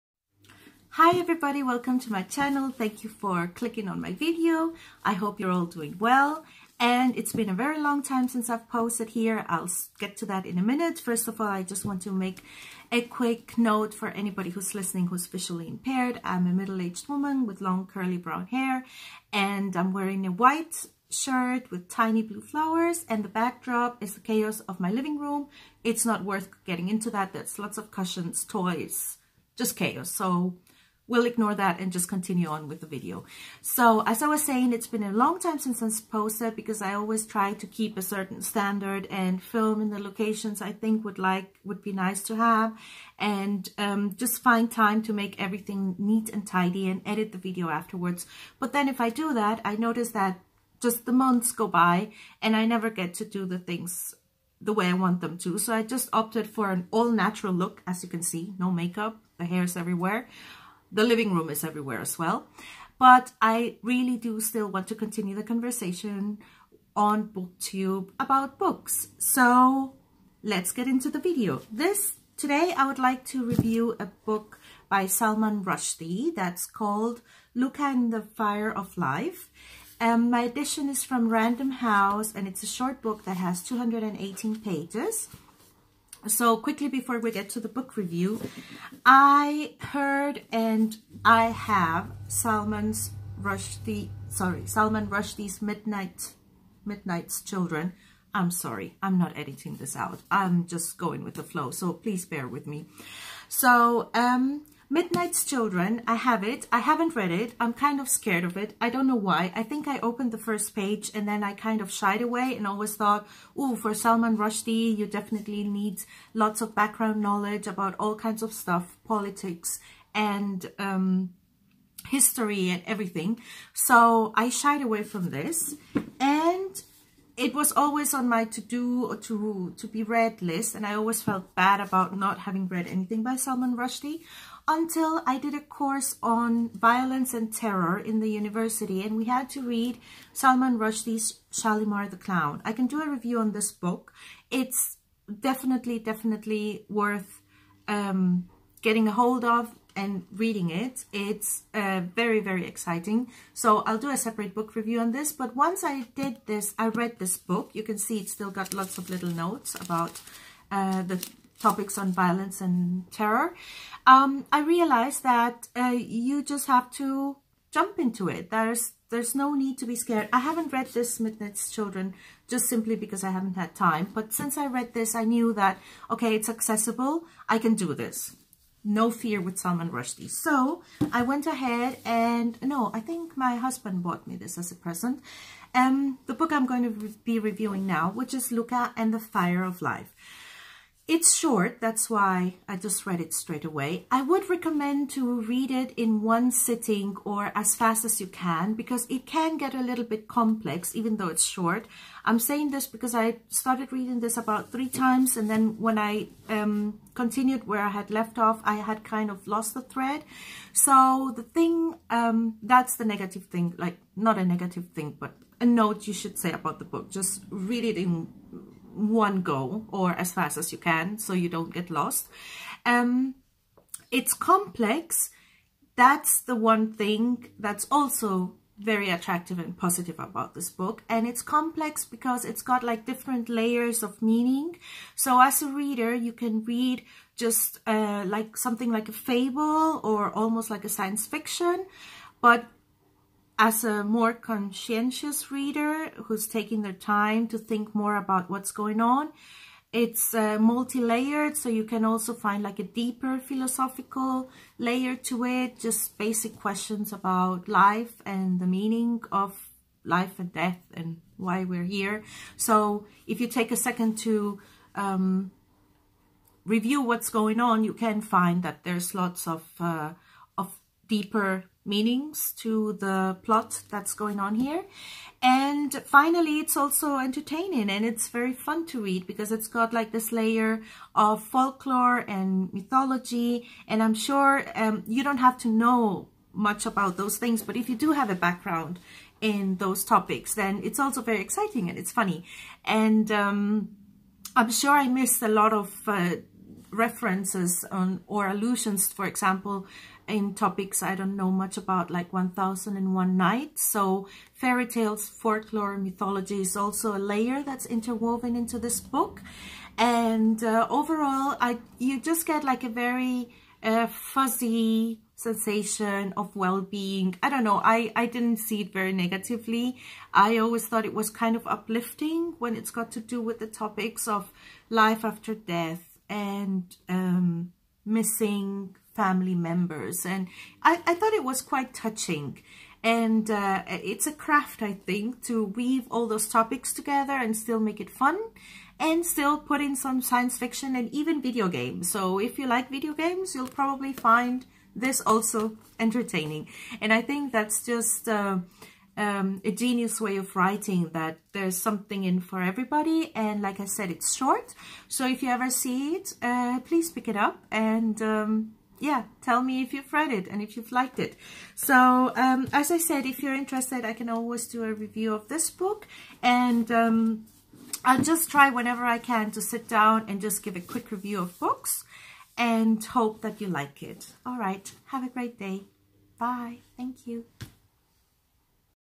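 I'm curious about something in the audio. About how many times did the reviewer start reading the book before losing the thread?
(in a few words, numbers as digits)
3.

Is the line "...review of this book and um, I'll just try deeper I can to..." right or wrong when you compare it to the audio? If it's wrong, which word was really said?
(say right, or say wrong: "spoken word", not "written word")
wrong: "whenever", not "deeper".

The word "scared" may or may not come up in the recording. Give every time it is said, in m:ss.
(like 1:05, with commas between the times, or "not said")
1:48, 2:49.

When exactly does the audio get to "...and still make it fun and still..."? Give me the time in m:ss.
5:37.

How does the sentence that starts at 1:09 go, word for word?
So let's get into the video.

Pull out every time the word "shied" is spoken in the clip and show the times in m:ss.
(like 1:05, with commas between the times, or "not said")
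1:51, 2:04.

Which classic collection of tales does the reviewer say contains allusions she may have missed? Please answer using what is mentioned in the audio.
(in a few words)
1001 Nights.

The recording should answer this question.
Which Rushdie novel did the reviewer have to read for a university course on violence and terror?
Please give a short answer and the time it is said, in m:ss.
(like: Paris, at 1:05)
Shalimar the Clown, at 2:21.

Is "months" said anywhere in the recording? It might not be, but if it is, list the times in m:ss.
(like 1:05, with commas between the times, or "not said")
0:51.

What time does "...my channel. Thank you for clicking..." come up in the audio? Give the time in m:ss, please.
0:02.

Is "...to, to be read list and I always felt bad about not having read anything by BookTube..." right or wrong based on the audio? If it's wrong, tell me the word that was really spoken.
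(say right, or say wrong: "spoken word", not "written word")
wrong: "Salman", not "BookTube".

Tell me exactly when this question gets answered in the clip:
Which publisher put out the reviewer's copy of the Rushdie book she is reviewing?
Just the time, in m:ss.
1:21.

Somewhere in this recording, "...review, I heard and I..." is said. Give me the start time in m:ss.
1:27.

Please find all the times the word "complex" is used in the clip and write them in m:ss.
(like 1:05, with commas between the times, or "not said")
3:20, 3:44, 3:51.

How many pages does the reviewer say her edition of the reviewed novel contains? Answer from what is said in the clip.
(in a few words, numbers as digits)
218.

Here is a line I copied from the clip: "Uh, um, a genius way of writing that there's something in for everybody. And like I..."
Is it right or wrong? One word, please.
right.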